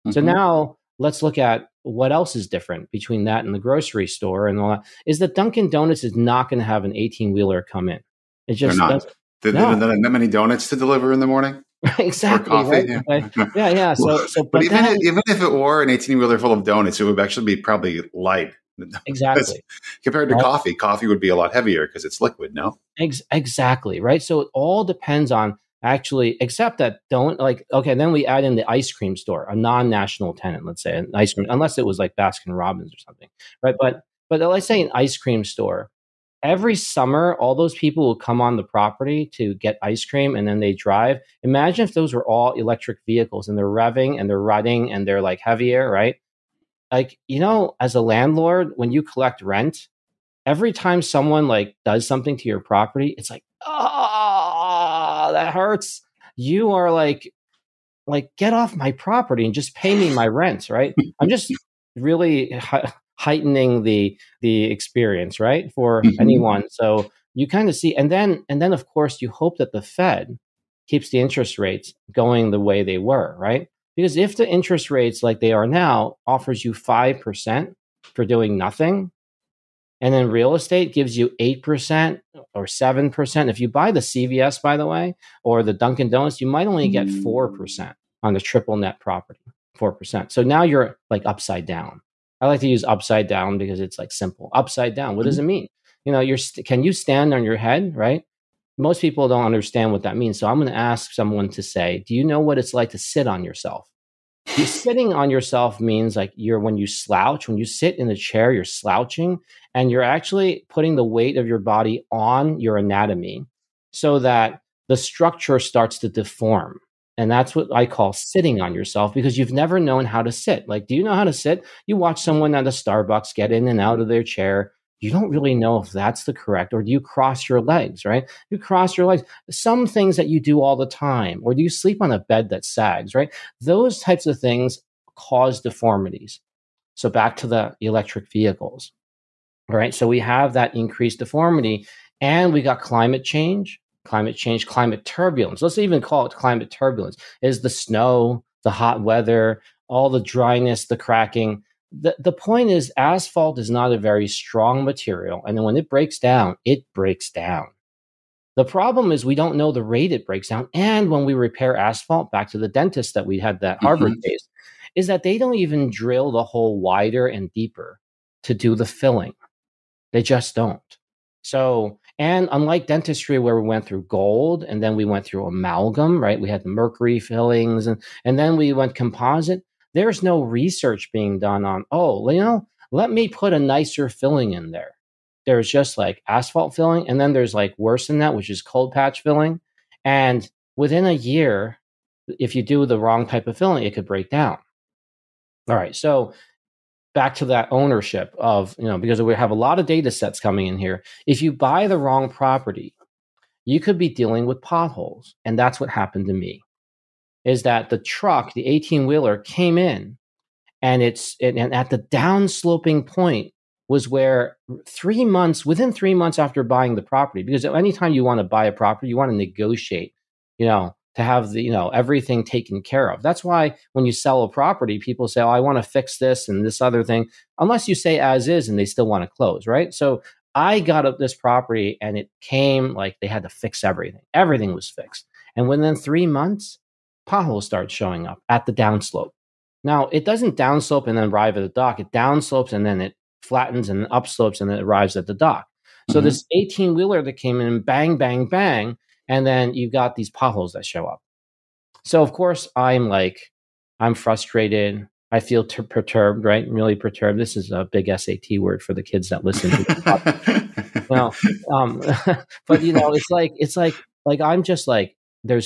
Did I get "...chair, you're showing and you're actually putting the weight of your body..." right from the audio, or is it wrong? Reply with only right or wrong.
wrong.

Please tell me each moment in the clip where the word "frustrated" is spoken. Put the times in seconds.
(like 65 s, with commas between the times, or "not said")
254 s.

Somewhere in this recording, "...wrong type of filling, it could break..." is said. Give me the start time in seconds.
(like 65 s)
192 s.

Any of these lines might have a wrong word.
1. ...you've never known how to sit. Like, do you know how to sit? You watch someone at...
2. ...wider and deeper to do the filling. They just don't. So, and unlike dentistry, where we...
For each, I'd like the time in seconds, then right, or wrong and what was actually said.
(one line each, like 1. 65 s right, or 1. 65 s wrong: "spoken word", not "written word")
1. 119 s right
2. 166 s right.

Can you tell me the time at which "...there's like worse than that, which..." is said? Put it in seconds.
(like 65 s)
187 s.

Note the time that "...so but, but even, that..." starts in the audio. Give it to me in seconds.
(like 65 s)
14 s.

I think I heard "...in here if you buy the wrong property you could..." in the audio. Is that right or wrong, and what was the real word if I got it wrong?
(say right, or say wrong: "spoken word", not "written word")
right.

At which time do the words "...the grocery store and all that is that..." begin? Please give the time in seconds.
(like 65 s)
3 s.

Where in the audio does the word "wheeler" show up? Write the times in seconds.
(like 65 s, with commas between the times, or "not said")
7 s, 16 s, 209 s, 246 s.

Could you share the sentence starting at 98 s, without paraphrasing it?
Most people don't understand what that means.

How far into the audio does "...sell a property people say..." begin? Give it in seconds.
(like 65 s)
224 s.